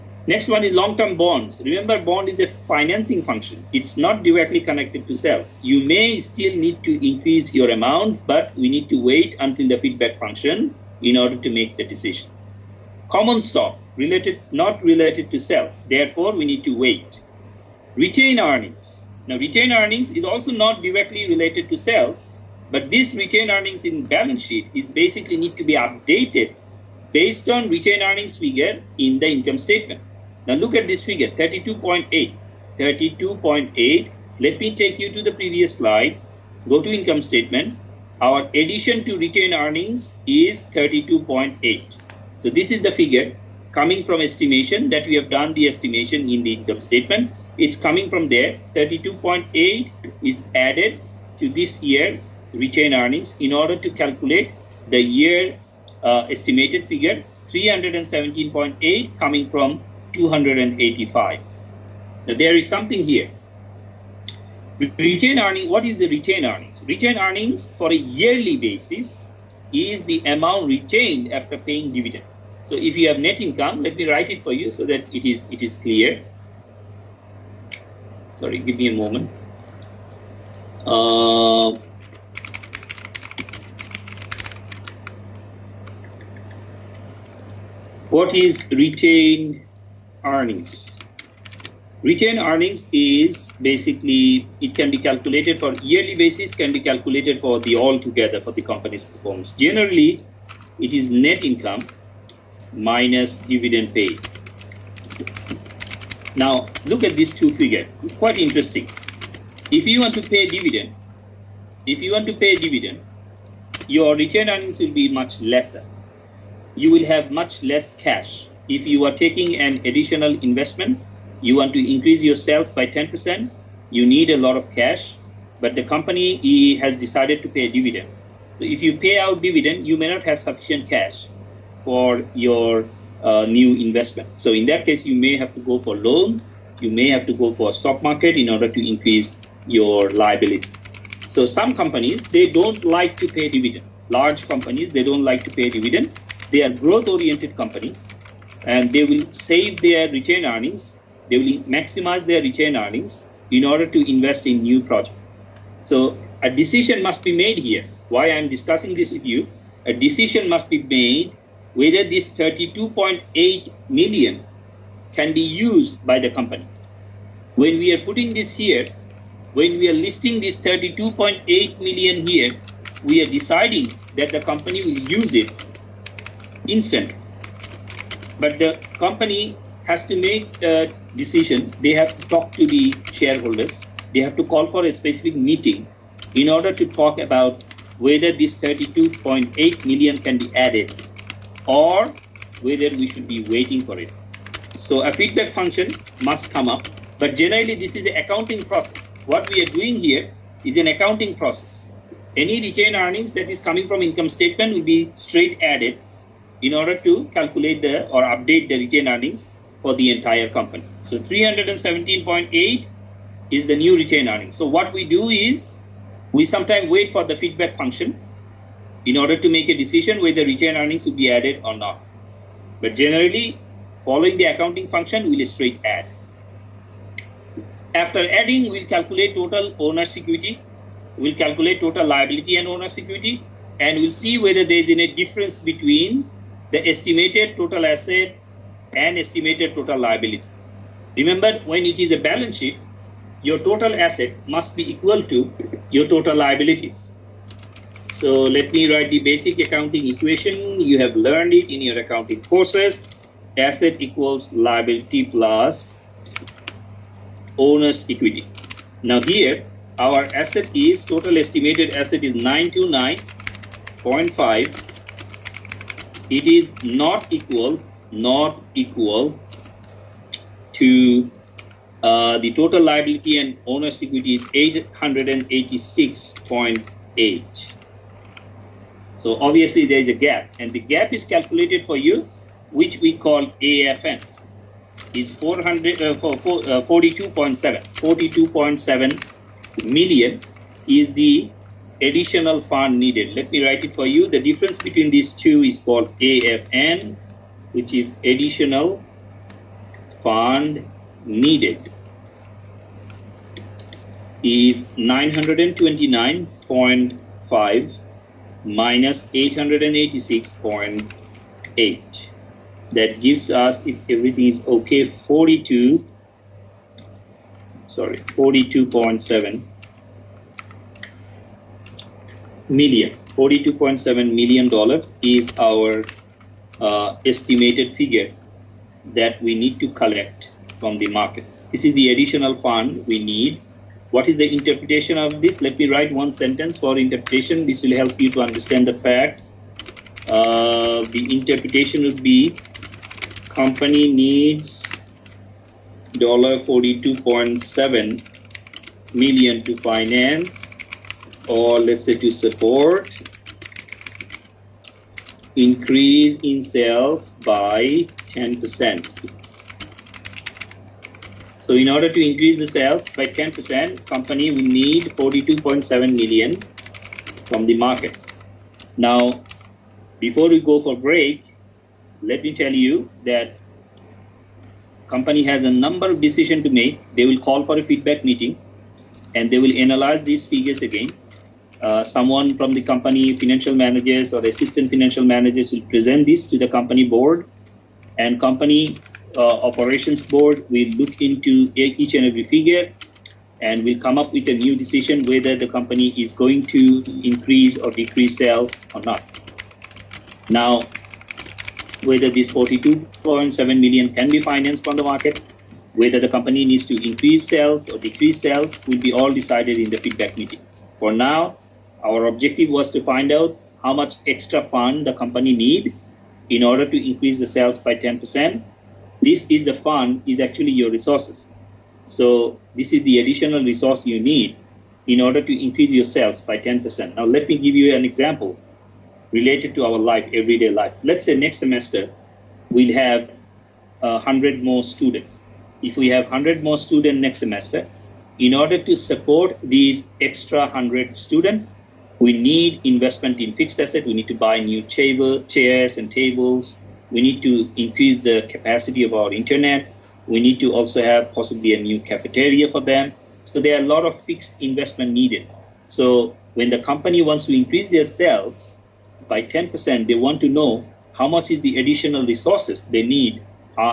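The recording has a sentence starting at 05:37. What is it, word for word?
This will help you to understand the fact.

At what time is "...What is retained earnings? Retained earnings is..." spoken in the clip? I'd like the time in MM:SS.
01:28.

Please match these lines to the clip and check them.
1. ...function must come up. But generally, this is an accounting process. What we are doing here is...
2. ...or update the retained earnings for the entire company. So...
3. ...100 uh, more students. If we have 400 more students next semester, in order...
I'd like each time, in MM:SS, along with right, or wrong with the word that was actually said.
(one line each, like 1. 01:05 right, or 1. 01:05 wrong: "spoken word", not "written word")
1. 03:15 right
2. 03:28 right
3. 07:14 wrong: "100", not "400".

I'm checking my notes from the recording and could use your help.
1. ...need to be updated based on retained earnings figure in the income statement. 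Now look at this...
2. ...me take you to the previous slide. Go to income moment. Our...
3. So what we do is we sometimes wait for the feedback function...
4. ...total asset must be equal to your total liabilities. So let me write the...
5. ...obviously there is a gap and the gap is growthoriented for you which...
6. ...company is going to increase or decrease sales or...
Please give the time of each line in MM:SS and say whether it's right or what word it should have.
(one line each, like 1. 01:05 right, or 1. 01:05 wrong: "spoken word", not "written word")
1. 00:25 right
2. 00:34 wrong: "statement", not "moment"
3. 03:34 right
4. 04:03 right
5. 04:39 wrong: "calculated", not "growthoriented"
6. 06:35 right.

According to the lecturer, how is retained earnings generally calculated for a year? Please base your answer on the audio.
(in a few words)
net income minus dividend paid.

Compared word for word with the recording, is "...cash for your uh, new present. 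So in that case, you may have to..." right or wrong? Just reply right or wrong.
wrong.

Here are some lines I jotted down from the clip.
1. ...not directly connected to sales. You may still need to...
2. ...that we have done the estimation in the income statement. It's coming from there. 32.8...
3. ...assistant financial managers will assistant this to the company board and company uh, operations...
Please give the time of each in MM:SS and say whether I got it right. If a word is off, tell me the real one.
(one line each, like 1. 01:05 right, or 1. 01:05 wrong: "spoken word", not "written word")
1. 00:03 right
2. 00:44 right
3. 06:24 wrong: "present", not "assistant".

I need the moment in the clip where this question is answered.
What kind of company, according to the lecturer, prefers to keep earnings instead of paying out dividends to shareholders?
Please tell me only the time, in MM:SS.
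02:26.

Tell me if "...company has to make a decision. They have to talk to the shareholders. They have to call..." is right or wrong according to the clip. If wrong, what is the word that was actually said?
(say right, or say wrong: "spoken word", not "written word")
right.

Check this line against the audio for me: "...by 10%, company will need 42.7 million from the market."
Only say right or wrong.
right.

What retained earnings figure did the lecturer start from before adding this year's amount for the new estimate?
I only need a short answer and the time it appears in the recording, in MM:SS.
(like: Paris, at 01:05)
285, at 01:00.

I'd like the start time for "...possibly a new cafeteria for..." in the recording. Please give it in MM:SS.
07:31.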